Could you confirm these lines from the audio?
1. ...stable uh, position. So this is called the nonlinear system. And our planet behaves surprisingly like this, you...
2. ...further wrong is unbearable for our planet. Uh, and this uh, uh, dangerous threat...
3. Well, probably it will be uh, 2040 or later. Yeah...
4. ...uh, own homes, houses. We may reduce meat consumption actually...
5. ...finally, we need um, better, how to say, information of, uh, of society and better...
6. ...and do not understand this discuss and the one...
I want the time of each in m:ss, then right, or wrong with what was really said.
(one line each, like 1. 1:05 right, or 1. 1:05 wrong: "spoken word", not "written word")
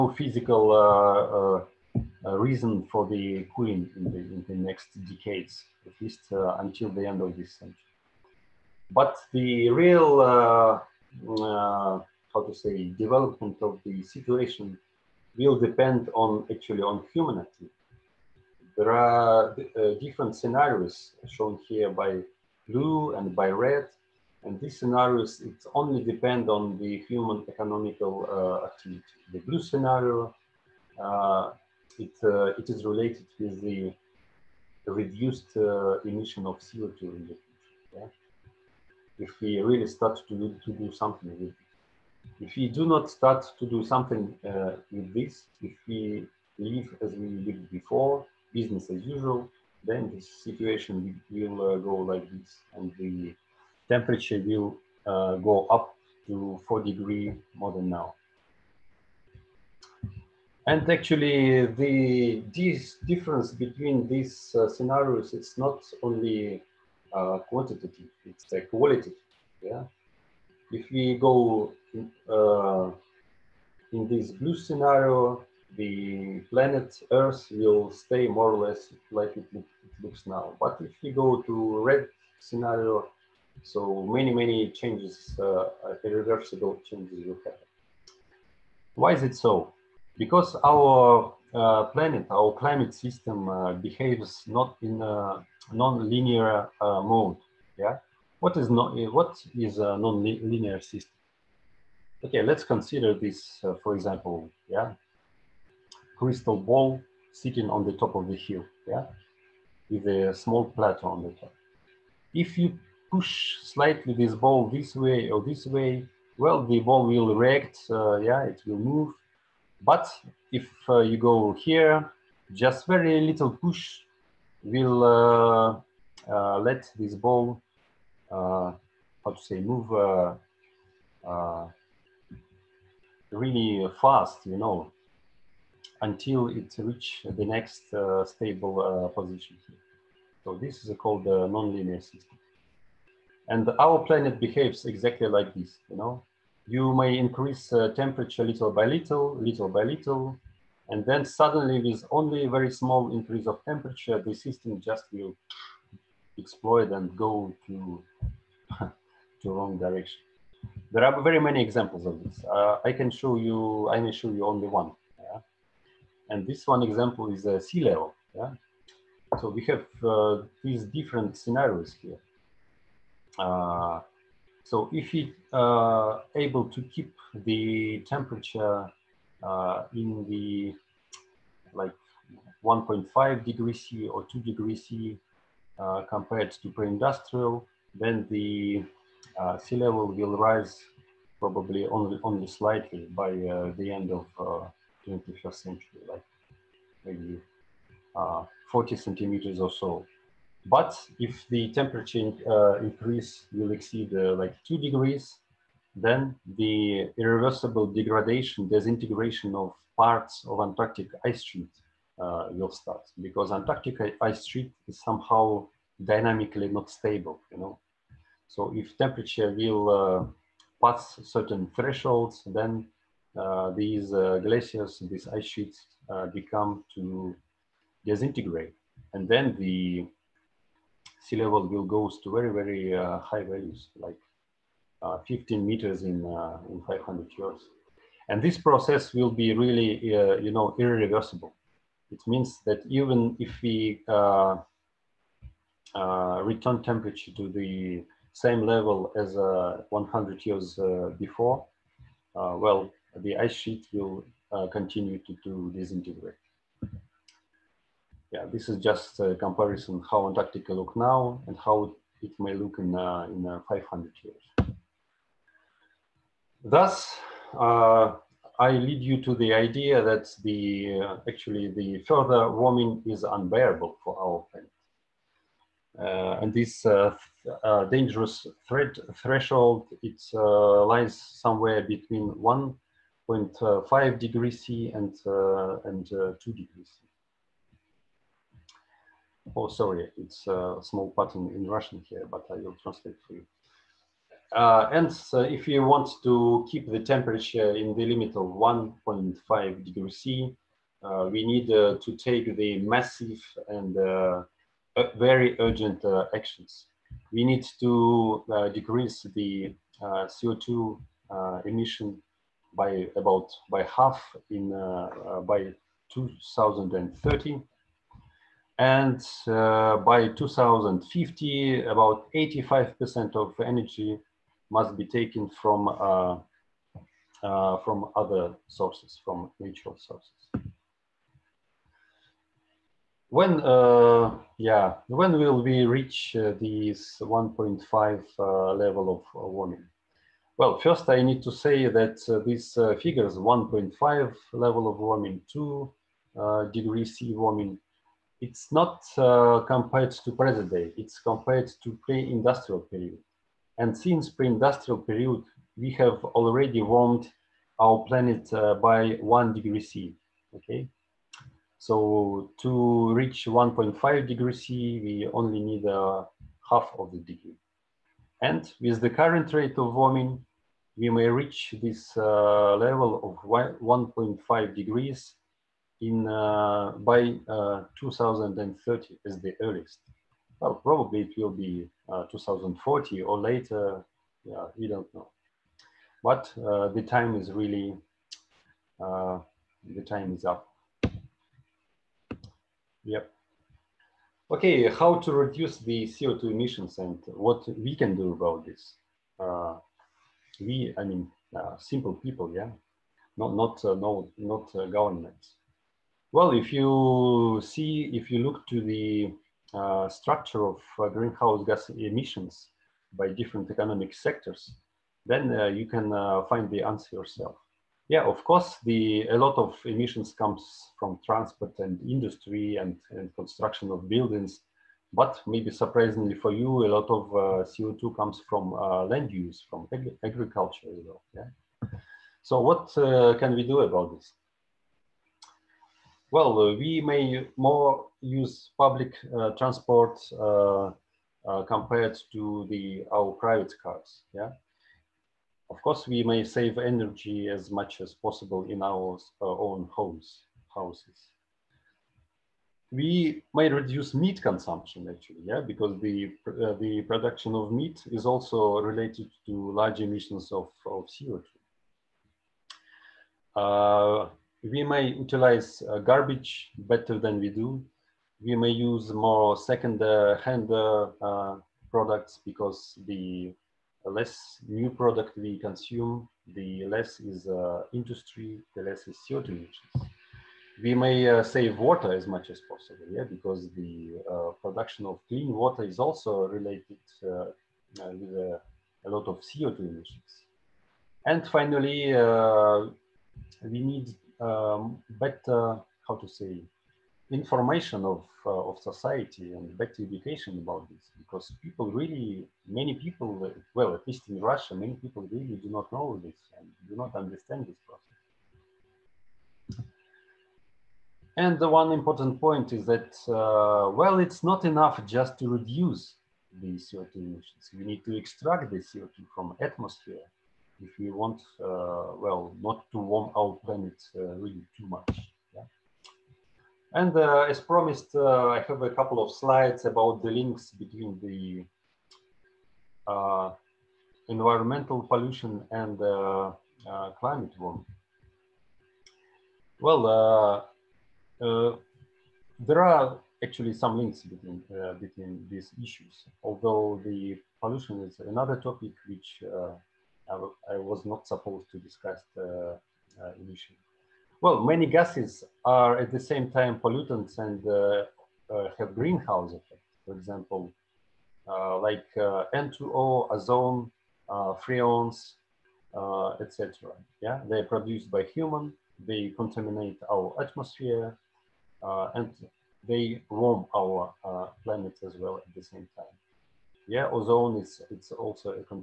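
1. 2:18 wrong: "exactly", not "surprisingly"
2. 4:32 wrong: "warming", not "wrong"
3. 6:20 right
4. 7:29 right
5. 8:11 right
6. 8:26 wrong: "process", not "discuss".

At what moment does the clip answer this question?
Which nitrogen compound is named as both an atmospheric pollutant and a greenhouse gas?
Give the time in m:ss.
9:22.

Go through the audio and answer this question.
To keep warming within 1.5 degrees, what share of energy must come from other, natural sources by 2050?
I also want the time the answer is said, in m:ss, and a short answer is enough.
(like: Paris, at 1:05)
85%, at 5:22.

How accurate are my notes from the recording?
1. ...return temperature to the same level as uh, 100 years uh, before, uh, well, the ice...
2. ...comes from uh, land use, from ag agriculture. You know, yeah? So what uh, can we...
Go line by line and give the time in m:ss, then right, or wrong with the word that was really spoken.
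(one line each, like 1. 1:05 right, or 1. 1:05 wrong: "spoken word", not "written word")
1. 4:06 right
2. 7:08 right.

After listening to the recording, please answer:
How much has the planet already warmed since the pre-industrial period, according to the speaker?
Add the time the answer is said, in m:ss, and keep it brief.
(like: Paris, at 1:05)
1 degree C, at 5:59.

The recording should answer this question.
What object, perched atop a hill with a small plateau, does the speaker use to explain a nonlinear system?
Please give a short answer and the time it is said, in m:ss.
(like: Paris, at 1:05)
crystal ball, at 1:46.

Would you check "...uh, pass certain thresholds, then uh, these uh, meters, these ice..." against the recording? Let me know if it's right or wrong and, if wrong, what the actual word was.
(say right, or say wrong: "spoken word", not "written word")
wrong: "glaciers", not "meters".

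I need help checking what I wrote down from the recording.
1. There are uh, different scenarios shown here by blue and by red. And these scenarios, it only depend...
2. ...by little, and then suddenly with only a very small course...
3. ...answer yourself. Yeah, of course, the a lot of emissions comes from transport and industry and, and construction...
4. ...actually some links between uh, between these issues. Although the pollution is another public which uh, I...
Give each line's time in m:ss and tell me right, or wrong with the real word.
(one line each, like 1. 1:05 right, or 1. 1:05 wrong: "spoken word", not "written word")
1. 0:18 right
2. 2:29 wrong: "increase", not "course"
3. 6:56 right
4. 9:03 wrong: "topic", not "public".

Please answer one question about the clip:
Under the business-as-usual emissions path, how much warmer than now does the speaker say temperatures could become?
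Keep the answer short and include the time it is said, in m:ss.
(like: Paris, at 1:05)
4 degrees, at 0:56.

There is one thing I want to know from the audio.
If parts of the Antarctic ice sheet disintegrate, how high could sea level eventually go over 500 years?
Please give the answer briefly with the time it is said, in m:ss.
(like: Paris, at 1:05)
15 meters, at 3:55.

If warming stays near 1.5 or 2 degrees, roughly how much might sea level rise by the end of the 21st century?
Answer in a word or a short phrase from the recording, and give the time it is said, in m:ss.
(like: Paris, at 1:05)
40 centimeters, at 3:18.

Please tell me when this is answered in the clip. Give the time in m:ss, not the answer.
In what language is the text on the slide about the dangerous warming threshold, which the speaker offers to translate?
4:51.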